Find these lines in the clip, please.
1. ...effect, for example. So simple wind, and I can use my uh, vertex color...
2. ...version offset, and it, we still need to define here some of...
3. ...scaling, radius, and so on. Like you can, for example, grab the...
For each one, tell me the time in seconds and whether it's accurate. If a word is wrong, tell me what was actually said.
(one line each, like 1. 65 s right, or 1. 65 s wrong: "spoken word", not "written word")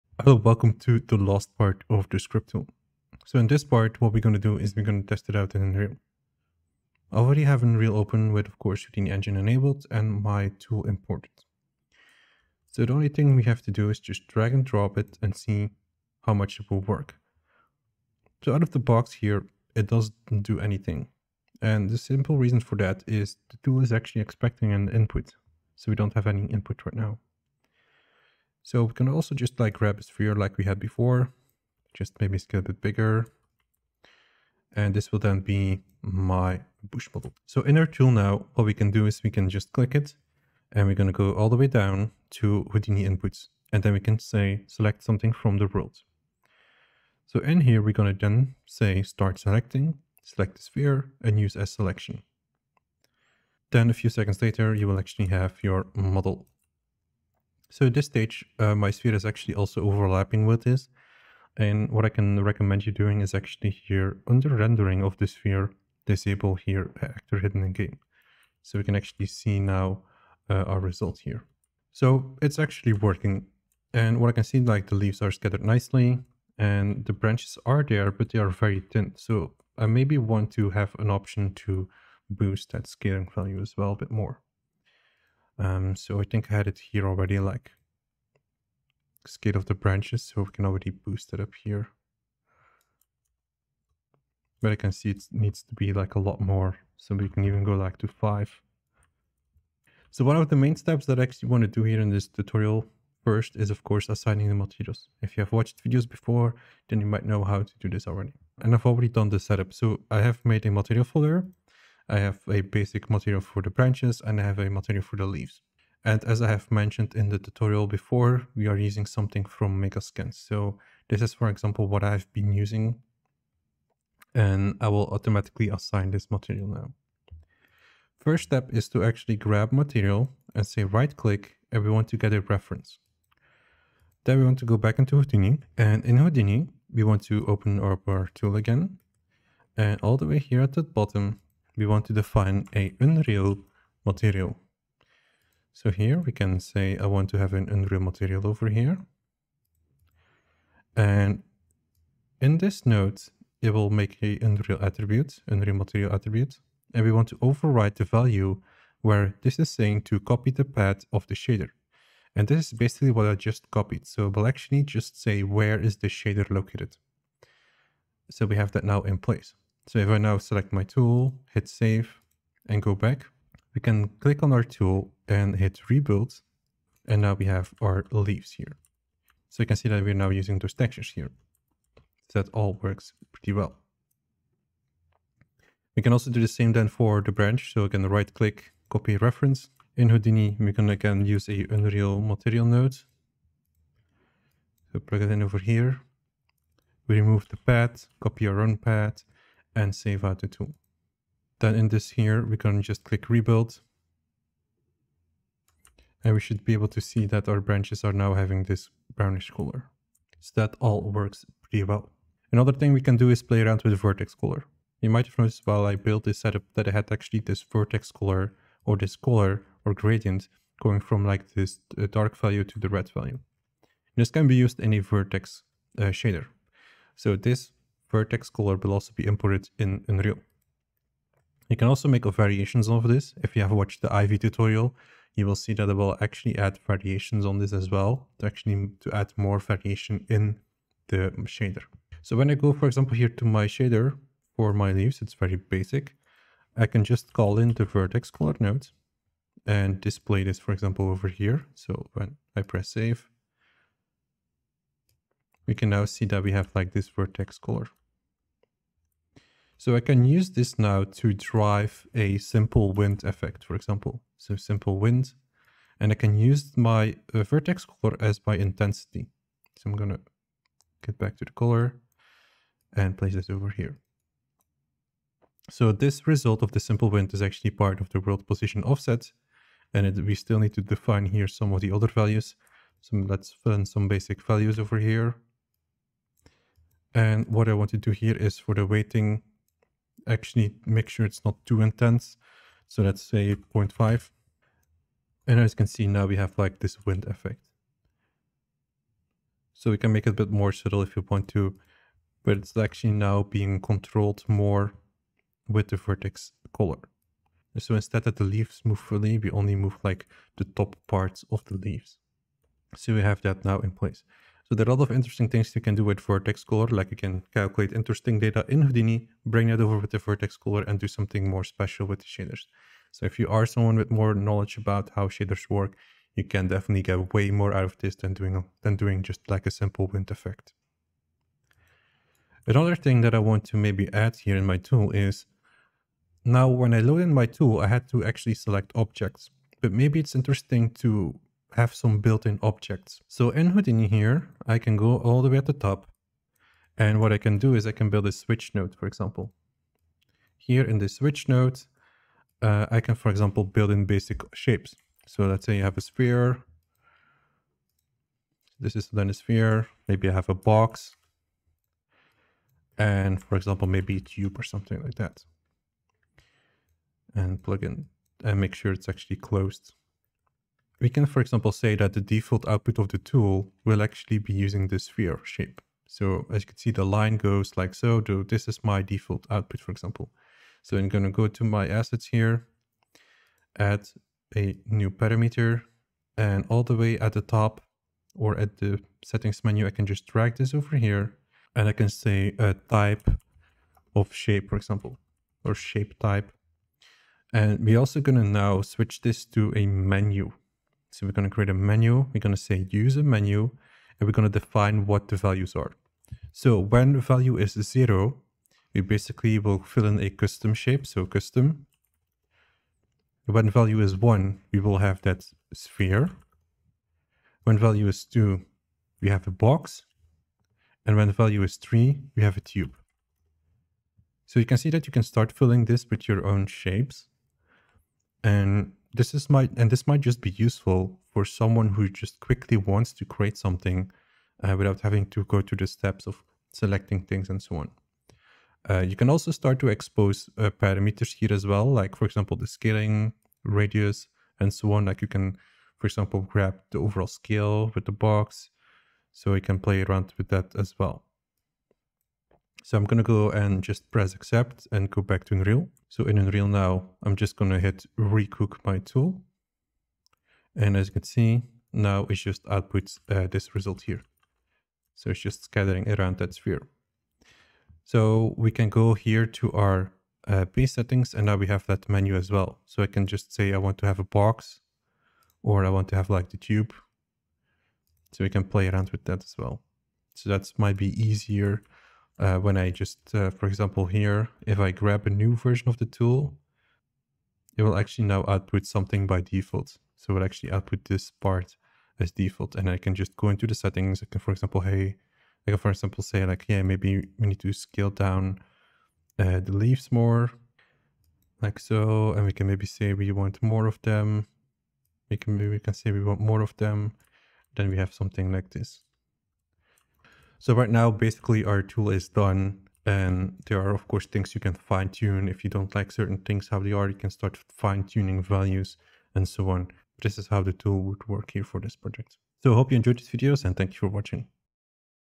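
1. 263 s right
2. 278 s wrong: "position", not "version"
3. 442 s right.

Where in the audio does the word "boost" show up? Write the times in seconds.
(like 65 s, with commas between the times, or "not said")
82 s, 90 s.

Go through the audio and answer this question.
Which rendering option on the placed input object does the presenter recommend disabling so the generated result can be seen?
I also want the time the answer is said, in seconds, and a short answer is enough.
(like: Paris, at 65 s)
actor hidden in game, at 67 s.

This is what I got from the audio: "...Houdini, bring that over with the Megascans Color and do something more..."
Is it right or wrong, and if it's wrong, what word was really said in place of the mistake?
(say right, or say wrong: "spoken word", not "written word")
wrong: "Vertex", not "Megascans".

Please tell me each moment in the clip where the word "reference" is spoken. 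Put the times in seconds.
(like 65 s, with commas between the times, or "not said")
132 s, 189 s.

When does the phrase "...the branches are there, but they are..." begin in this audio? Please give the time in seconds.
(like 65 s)
77 s.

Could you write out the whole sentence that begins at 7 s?
I already have Unreal open with, of course, Houdini Engine enabled and my tool imported.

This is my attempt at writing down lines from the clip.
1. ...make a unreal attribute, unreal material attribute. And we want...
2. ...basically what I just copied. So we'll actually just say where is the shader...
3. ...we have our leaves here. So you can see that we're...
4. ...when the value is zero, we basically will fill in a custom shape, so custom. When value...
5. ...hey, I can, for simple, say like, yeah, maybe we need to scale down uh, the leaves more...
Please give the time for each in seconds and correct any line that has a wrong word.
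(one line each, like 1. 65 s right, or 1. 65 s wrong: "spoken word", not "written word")
1. 153 s right
2. 162 s right
3. 177 s right
4. 406 s right
5. 494 s wrong: "example", not "simple".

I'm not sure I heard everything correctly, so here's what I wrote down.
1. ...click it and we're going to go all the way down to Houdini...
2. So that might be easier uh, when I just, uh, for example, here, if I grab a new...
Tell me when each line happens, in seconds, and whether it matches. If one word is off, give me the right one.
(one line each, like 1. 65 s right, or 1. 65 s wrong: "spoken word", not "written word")
1. 39 s right
2. 480 s right.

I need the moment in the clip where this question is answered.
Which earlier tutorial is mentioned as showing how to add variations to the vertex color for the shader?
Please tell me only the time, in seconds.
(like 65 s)
234 s.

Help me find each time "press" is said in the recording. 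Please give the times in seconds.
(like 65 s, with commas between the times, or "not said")
252 s, 454 s.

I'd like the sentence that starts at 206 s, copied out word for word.
And we should be able to see that our branches are now having this brownish color.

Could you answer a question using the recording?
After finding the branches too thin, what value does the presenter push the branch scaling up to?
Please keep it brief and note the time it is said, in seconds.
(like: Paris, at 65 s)
5, at 98 s.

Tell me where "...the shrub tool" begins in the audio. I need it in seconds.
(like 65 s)
2 s.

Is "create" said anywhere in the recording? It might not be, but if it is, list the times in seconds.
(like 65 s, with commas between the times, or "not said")
401 s, 433 s.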